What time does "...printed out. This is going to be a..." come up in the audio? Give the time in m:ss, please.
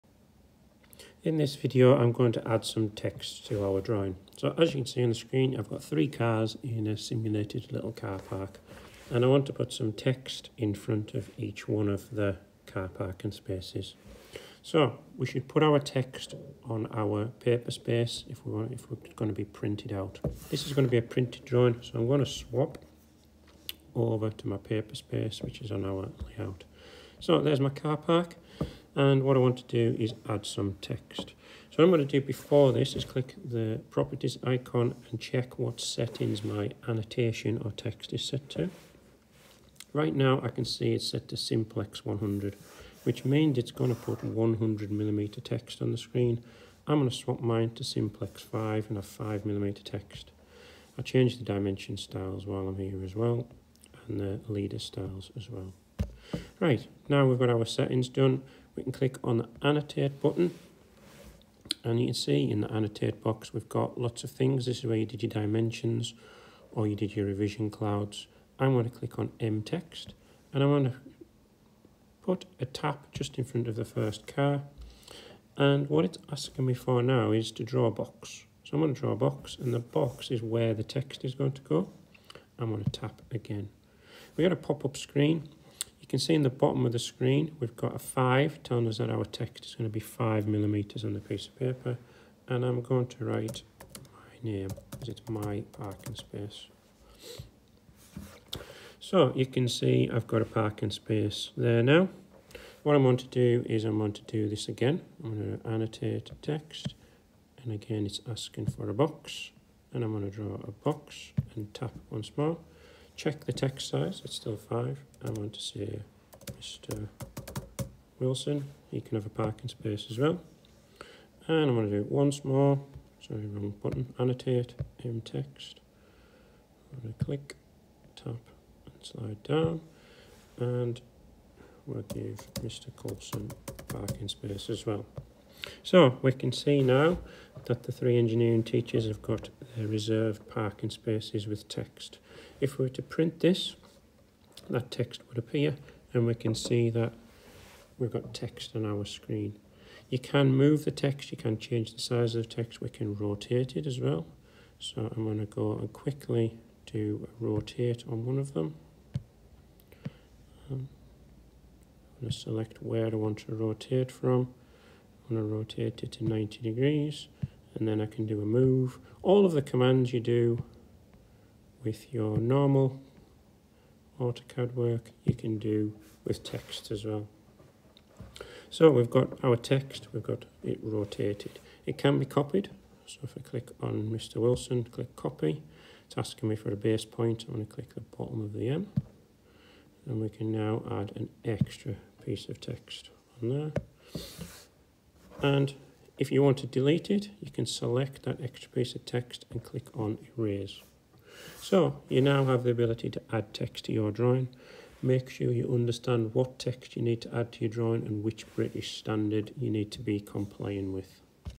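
0:19.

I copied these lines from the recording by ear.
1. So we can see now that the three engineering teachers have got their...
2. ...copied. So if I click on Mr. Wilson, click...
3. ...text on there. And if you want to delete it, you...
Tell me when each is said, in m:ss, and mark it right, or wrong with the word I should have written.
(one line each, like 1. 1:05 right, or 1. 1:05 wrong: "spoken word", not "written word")
1. 2:15 right
2. 3:02 right
3. 3:12 right.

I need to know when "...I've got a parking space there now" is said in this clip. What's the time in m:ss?
1:40.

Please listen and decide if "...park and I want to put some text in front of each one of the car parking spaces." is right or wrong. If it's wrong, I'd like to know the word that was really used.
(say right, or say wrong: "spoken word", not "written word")
right.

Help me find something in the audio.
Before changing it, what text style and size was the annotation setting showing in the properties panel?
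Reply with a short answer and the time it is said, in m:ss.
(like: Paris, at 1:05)
simplex 100, at 0:41.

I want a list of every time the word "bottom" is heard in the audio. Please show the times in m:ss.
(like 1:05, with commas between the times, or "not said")
1:26, 3:08.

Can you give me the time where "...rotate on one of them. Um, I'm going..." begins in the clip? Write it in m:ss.
2:37.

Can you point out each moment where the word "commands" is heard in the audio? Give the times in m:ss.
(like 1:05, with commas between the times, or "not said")
2:49.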